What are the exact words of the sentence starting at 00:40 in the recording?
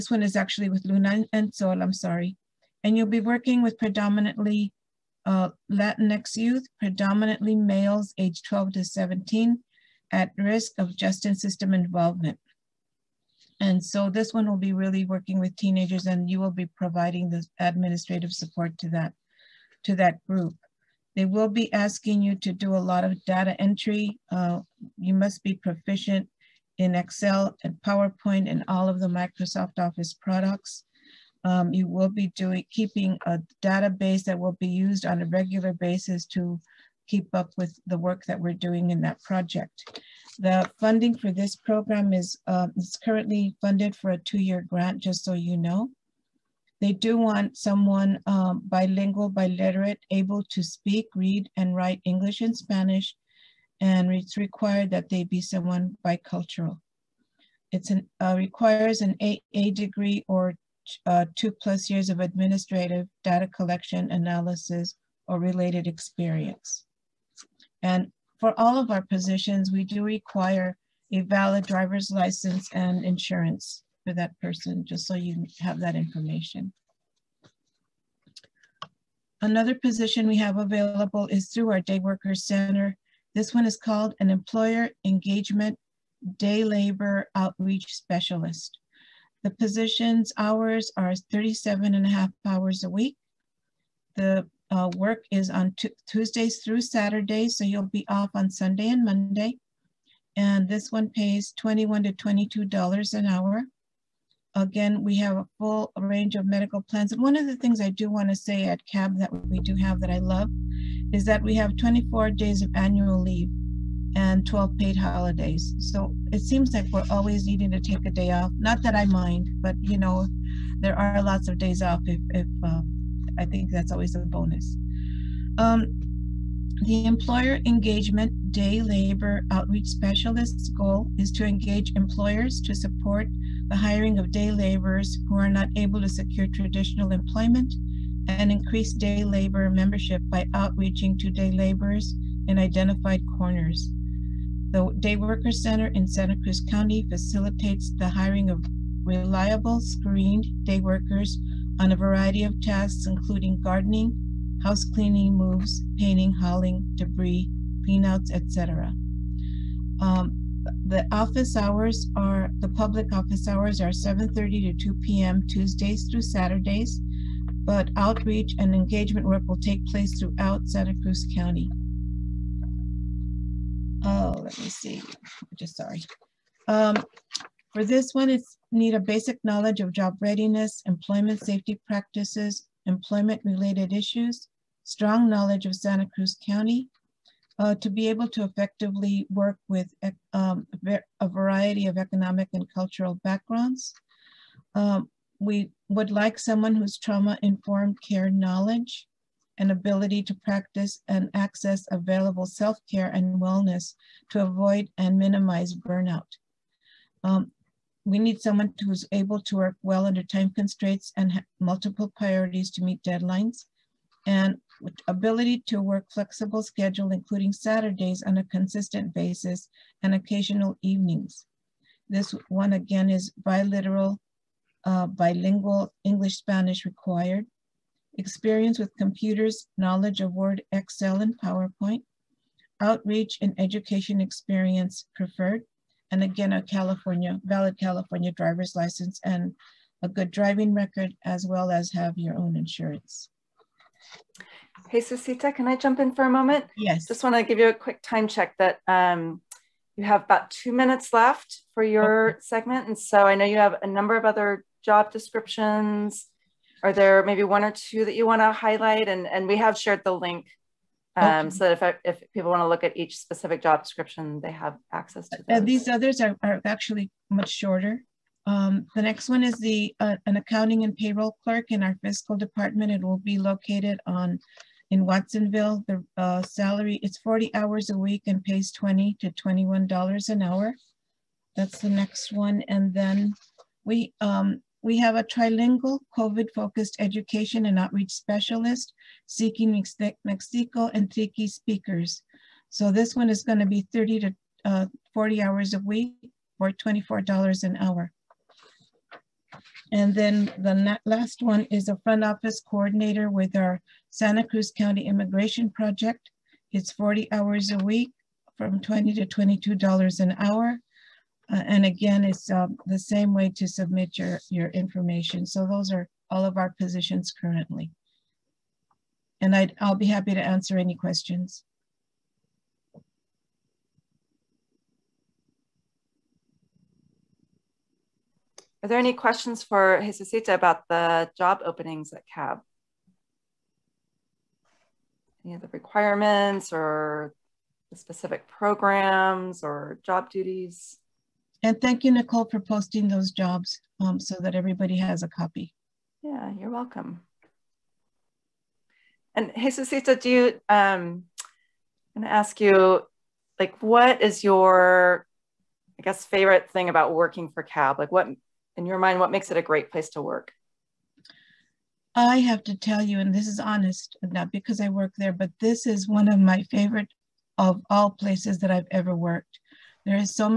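The funding for this program is uh, um, it's currently funded for a two-year grant, just so you know.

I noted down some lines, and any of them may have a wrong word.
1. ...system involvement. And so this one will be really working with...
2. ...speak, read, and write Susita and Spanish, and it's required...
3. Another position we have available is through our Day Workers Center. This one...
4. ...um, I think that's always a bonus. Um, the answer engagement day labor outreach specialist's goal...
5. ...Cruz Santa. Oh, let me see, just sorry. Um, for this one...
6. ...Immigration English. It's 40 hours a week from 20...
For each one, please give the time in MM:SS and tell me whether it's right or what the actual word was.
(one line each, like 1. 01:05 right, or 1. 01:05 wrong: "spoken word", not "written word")
1. 00:11 right
2. 00:50 wrong: "English", not "Susita"
3. 01:19 right
4. 02:02 wrong: "employer", not "answer"
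5. 02:51 wrong: "County", not "Santa"
6. 05:05 wrong: "Project", not "English".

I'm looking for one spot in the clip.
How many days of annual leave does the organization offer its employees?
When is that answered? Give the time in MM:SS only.
01:51.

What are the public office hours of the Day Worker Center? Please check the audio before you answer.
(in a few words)
7:30 to 2 p.m.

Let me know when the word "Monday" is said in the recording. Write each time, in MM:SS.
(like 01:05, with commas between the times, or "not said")
01:39.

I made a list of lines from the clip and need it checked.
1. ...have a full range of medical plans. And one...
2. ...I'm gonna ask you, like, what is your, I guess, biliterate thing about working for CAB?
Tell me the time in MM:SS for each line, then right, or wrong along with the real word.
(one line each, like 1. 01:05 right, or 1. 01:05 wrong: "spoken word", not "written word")
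1. 01:45 right
2. 05:52 wrong: "favorite", not "biliterate".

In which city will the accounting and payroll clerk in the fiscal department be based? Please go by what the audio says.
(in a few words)
Watsonville.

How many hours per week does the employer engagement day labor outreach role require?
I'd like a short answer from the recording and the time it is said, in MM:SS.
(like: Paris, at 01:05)
37.5, at 01:31.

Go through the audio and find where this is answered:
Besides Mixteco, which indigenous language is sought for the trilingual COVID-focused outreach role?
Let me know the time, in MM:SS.
04:51.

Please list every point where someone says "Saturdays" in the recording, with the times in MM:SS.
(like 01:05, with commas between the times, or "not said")
01:36, 02:46, 03:37.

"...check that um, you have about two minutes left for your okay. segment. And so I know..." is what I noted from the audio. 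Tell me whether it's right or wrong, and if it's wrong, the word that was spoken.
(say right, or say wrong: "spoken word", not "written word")
right.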